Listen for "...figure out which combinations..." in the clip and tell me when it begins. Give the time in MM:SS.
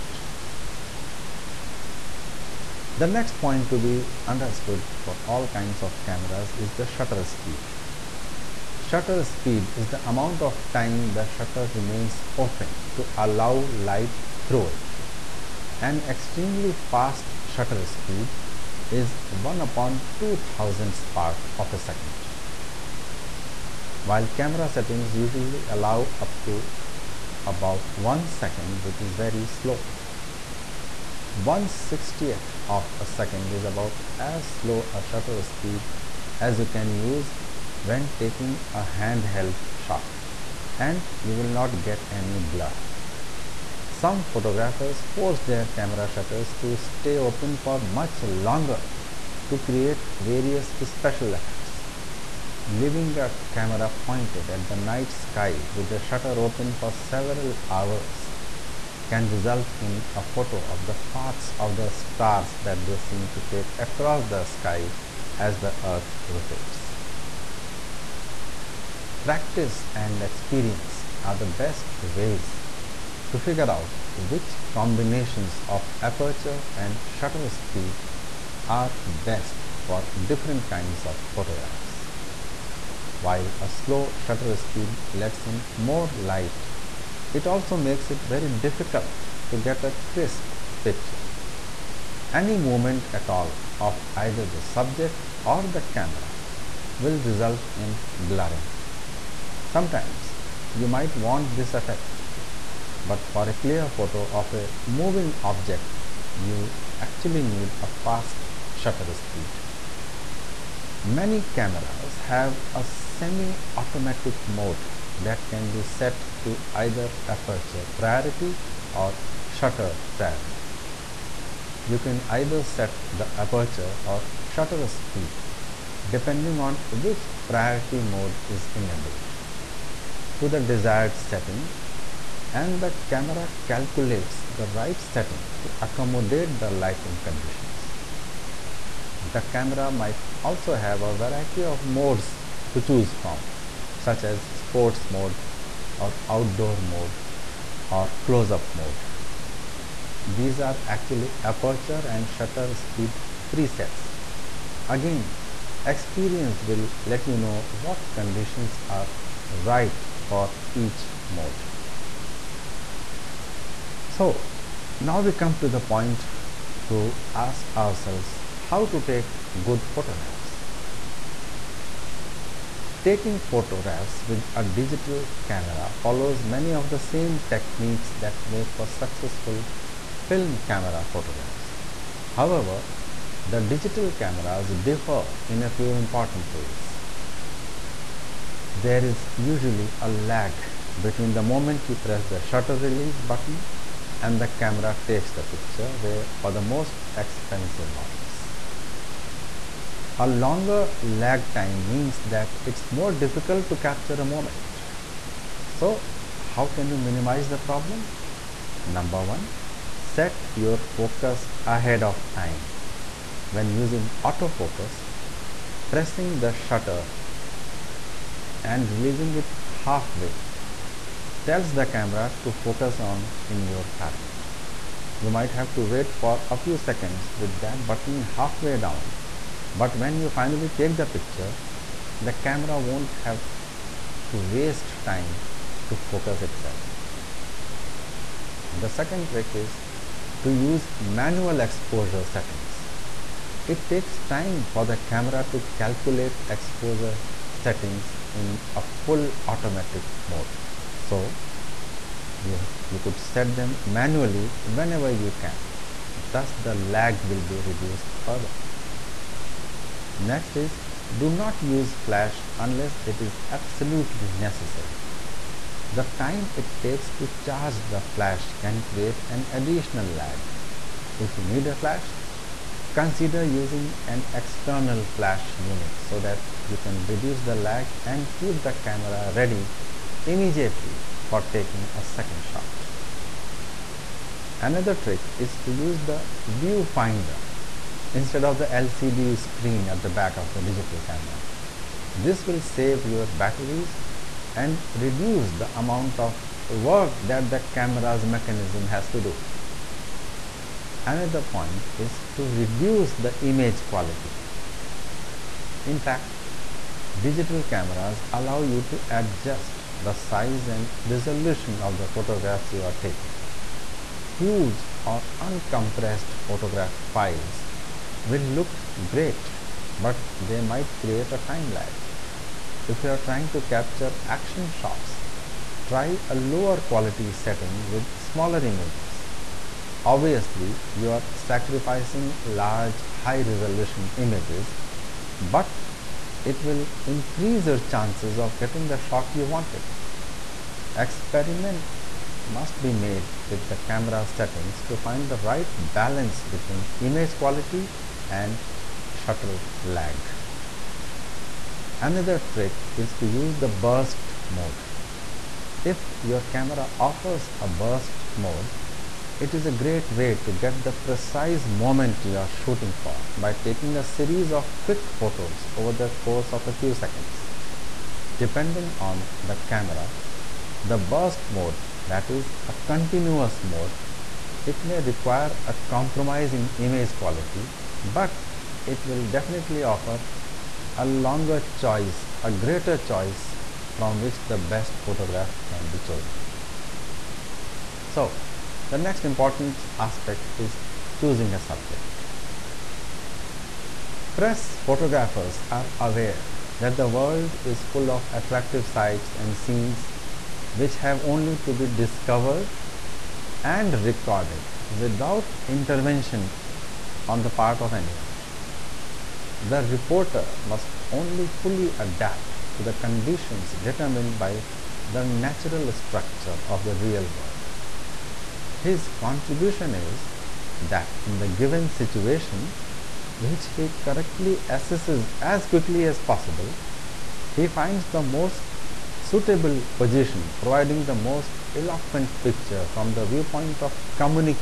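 01:13.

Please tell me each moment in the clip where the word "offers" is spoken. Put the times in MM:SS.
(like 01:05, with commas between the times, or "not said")
05:56, 06:19.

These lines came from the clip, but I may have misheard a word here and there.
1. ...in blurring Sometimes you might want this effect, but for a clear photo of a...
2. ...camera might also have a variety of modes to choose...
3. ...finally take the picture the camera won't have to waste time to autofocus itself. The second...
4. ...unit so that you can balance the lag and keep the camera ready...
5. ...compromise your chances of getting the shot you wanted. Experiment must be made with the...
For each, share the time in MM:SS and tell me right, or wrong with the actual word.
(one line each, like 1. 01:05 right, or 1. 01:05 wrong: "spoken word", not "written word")
1. 01:37 right
2. 02:19 right
3. 03:50 wrong: "focus", not "autofocus"
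4. 04:35 wrong: "reduce", not "balance"
5. 05:37 wrong: "increase", not "compromise".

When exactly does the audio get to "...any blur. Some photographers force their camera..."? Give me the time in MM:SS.
00:42.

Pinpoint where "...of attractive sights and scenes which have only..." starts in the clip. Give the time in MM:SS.
06:38.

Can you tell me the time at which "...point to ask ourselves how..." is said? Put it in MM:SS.
02:45.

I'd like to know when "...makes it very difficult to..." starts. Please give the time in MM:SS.
01:27.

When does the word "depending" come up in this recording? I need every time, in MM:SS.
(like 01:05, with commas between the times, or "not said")
02:06, 06:08.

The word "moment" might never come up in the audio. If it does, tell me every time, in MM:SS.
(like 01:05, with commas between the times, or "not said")
03:11, 03:24, 06:01.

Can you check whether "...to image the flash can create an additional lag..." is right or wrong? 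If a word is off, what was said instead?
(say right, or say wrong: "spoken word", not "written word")
wrong: "charge", not "image".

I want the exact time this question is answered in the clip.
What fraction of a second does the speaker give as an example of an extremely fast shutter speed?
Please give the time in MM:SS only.
00:19.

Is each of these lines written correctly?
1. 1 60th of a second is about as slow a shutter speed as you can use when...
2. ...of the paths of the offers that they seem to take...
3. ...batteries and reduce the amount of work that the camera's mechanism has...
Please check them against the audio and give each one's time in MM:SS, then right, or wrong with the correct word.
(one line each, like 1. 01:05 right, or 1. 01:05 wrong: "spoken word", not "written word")
1. 00:31 right
2. 01:00 wrong: "stars", not "offers"
3. 04:53 right.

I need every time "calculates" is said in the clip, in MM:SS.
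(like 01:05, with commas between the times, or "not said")
02:13, 04:05.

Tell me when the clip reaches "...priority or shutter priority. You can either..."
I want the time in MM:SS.
01:57.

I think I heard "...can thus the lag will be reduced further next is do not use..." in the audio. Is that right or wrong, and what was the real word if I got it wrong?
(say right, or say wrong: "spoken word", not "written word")
right.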